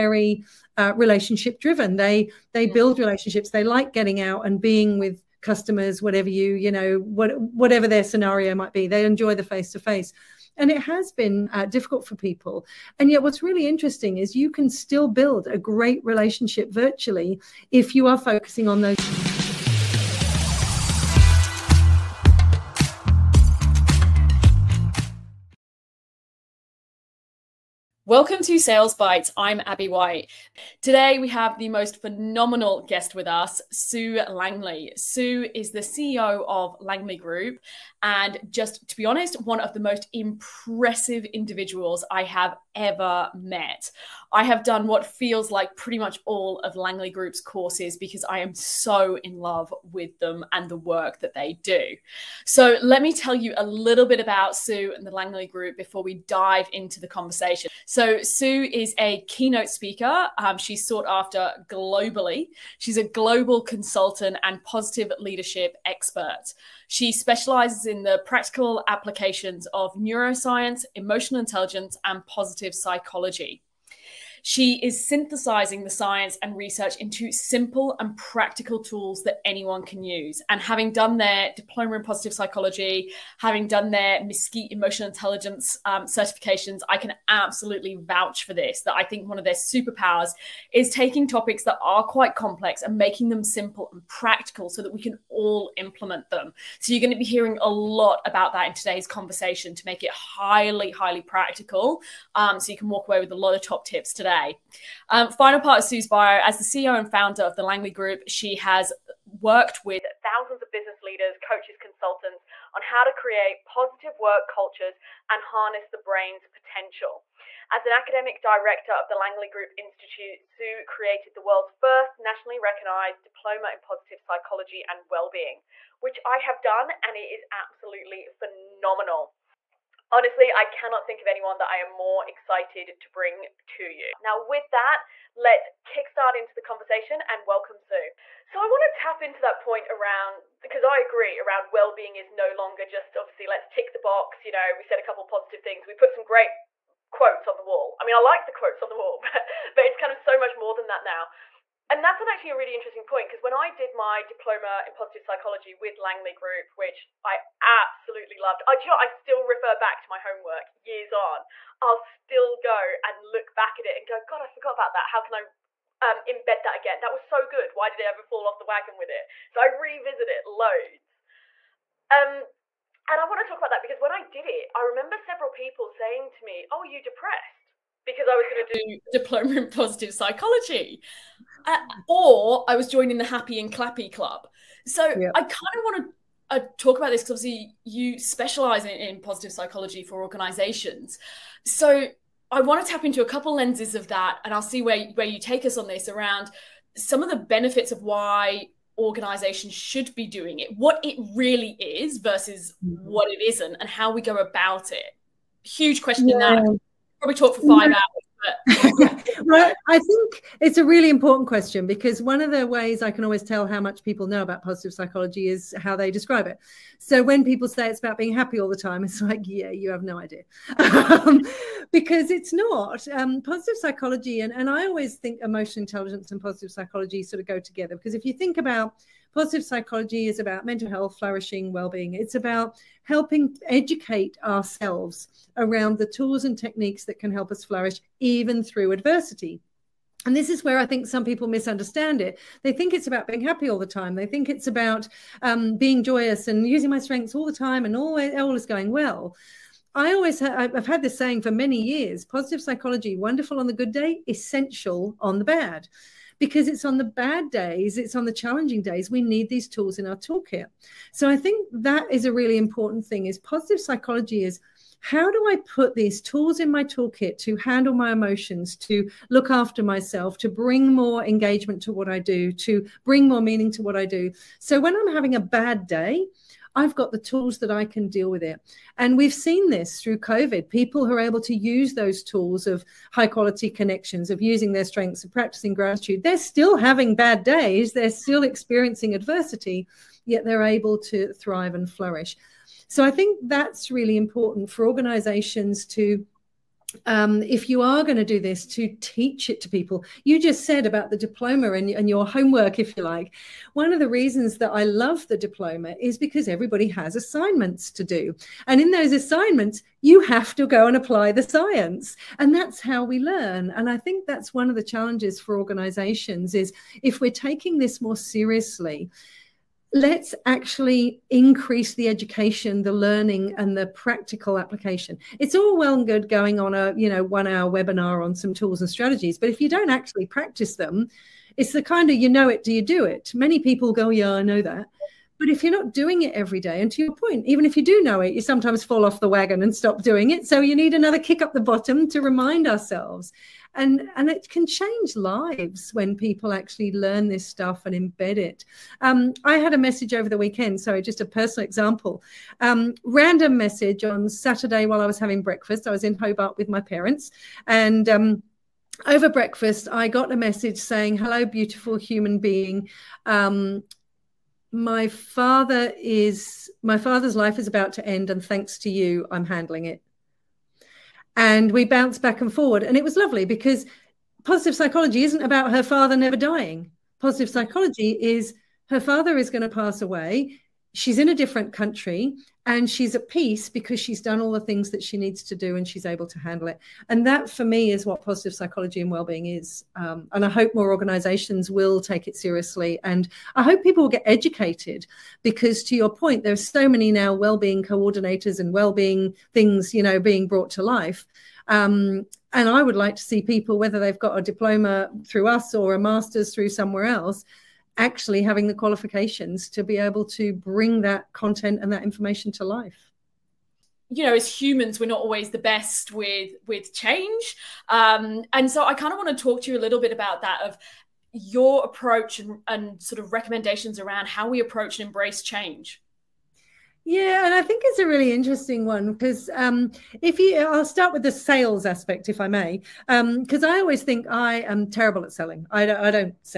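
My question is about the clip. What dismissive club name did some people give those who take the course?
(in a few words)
happy and clappy club.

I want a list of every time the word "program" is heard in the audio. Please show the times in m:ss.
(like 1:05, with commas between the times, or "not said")
not said.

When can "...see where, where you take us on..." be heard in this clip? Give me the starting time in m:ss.
3:14.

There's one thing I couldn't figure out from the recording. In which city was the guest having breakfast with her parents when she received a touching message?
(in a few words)
Hobart.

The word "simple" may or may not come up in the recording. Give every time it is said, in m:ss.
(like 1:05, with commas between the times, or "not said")
1:17, 1:33.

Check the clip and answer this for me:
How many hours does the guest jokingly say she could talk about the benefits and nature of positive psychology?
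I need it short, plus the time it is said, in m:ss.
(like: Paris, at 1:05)
5, at 3:27.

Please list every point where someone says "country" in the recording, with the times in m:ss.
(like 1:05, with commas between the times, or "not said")
6:21.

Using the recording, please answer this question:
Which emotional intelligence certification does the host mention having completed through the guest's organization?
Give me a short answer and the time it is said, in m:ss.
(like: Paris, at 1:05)
MSCEIT, at 1:24.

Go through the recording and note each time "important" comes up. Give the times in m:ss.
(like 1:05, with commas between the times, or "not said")
3:31, 4:22, 4:54.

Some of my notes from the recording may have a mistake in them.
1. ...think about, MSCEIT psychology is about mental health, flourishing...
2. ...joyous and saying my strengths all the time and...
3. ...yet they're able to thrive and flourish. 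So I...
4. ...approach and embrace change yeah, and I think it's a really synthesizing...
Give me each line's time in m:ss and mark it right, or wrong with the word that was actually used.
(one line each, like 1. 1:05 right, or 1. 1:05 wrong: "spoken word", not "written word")
1. 3:48 wrong: "Positive", not "MSCEIT"
2. 4:06 wrong: "using", not "saying"
3. 4:50 right
4. 7:04 wrong: "interesting", not "synthesizing".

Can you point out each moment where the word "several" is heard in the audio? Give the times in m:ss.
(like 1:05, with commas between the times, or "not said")
2:55.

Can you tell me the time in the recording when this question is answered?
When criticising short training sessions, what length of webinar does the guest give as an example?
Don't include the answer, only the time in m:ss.
5:27.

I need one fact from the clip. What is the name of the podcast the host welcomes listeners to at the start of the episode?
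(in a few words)
Sales Bites.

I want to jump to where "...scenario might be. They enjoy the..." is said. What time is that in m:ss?
0:08.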